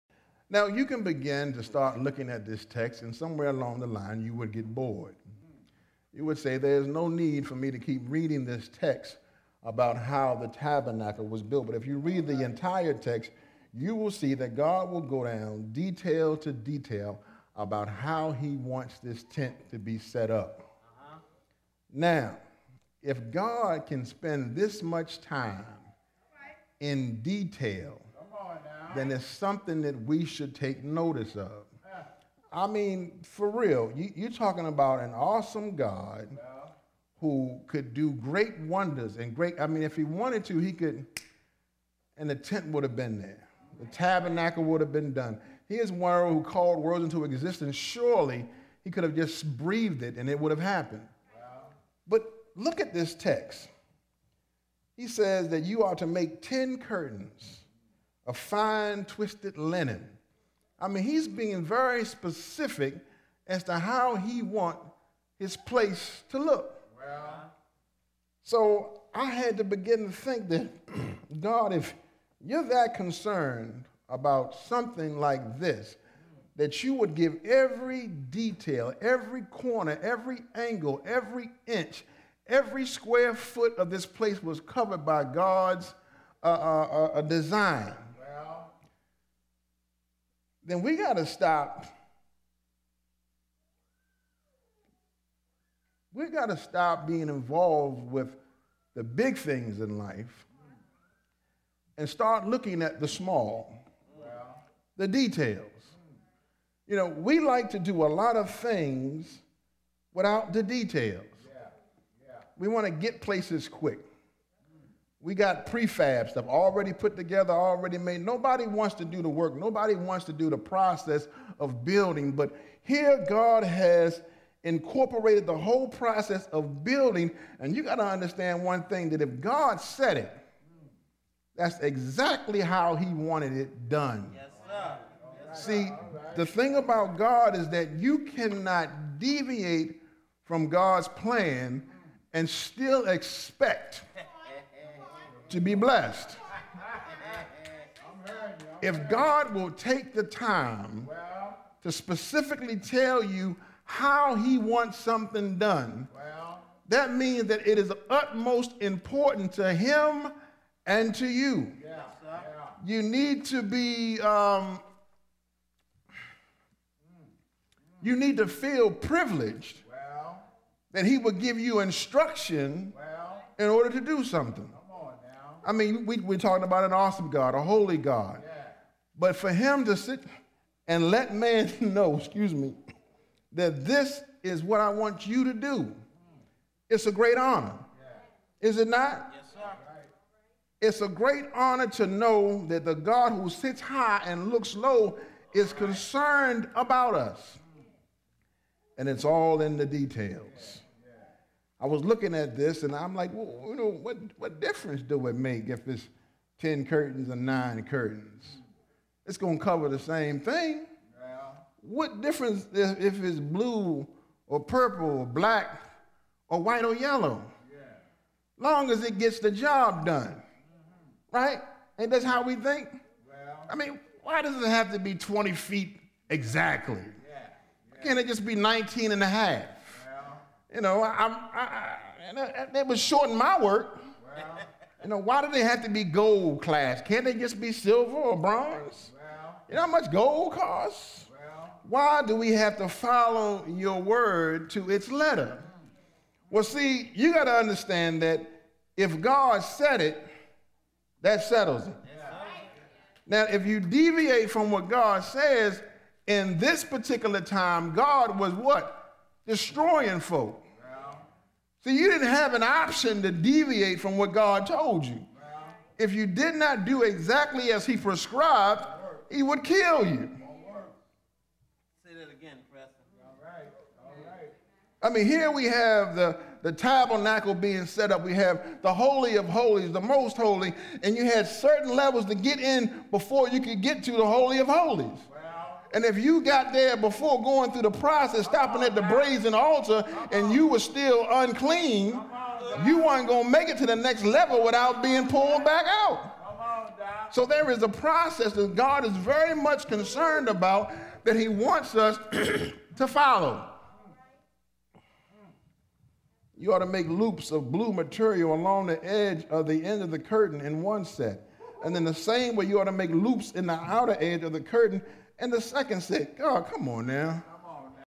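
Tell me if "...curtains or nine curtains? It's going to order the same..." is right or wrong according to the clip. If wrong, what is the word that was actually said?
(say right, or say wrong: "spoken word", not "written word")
wrong: "cover", not "order".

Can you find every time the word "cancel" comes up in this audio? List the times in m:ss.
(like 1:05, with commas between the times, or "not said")
not said.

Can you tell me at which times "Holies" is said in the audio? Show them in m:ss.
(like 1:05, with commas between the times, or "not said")
4:39, 4:44.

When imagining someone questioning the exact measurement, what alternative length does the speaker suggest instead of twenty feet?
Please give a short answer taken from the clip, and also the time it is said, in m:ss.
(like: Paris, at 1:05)
19 and a half, at 3:48.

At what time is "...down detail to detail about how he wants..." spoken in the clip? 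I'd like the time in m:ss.
0:15.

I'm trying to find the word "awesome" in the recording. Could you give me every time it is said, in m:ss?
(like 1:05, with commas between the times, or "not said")
0:35, 2:56.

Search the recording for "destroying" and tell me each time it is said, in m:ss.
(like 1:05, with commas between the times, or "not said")
4:19.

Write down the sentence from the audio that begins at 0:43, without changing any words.
The tabernacle would have been done.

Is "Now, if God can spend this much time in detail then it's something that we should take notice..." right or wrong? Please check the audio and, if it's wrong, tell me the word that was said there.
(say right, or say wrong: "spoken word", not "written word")
right.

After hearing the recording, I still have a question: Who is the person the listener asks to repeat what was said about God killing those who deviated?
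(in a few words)
Preston.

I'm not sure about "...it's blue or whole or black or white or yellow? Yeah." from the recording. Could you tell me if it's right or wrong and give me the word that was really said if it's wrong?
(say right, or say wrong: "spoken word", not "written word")
wrong: "purple", not "whole".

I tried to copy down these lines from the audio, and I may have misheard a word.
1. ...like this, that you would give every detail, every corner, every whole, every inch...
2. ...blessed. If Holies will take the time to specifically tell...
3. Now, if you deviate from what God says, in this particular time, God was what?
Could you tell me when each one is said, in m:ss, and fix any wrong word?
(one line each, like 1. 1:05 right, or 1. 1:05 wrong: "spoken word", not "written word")
1. 1:15 wrong: "angle", not "whole"
2. 2:25 wrong: "God", not "Holies"
3. 4:13 right.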